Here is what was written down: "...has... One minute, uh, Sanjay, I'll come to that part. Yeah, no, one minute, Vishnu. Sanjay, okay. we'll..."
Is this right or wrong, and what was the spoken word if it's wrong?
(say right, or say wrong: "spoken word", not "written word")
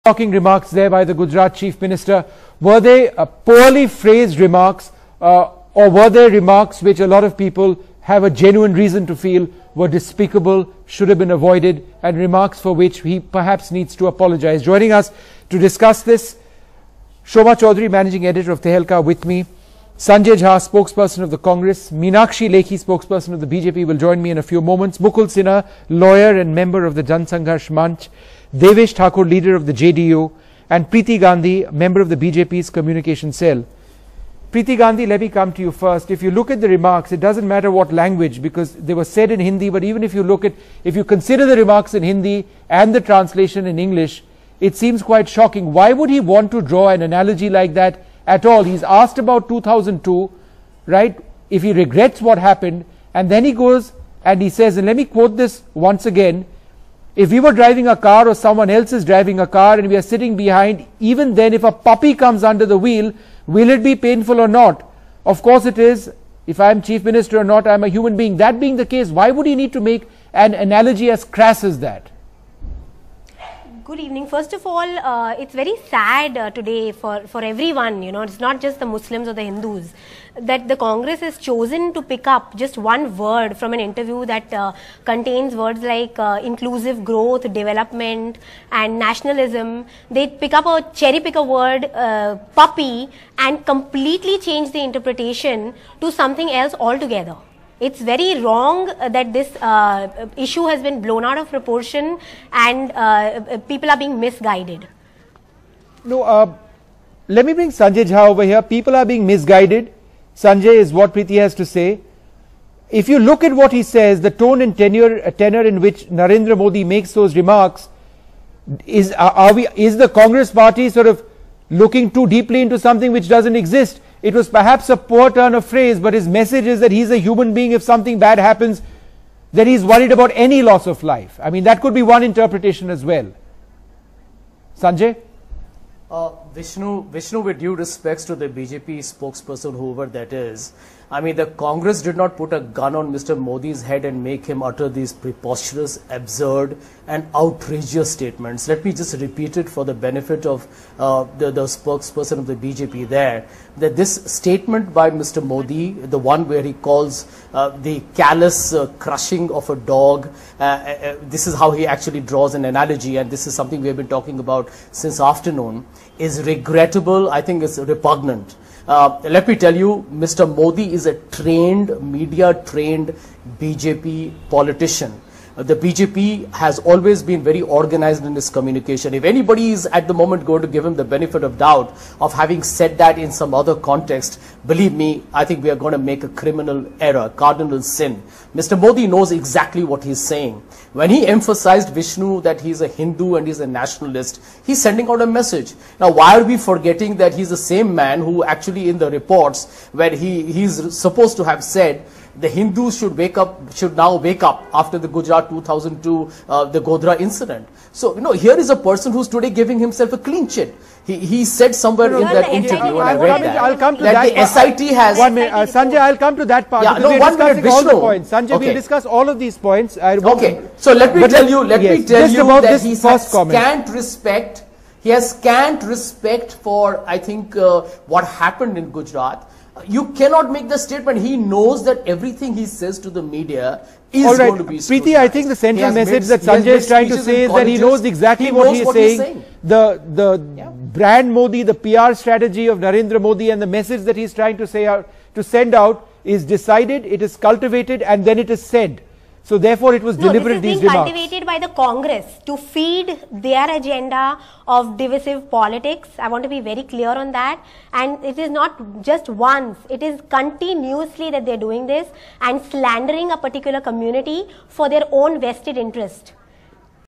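right.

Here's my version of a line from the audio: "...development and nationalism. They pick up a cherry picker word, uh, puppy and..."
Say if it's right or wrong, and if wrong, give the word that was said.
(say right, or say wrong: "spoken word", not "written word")
right.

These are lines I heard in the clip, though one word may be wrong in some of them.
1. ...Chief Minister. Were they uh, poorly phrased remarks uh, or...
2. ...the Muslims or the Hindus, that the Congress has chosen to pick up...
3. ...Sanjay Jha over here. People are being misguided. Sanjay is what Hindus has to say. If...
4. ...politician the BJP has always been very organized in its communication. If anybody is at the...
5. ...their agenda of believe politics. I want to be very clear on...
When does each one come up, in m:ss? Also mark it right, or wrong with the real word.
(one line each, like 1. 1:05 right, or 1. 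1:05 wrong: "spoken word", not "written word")
1. 0:01 right
2. 1:18 right
3. 1:47 wrong: "Preeti", not "Hindus"
4. 2:54 right
5. 4:13 wrong: "divisive", not "believe".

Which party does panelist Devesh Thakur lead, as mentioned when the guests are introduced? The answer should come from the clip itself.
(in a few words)
JDU.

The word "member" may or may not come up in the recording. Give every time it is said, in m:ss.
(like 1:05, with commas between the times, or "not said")
0:26, 0:31.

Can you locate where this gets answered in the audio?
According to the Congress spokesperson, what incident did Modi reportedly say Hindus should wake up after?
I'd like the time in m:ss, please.
3:26.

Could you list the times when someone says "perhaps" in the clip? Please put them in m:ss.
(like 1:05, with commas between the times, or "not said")
0:13, 2:04.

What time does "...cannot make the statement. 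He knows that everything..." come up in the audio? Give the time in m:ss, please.
3:50.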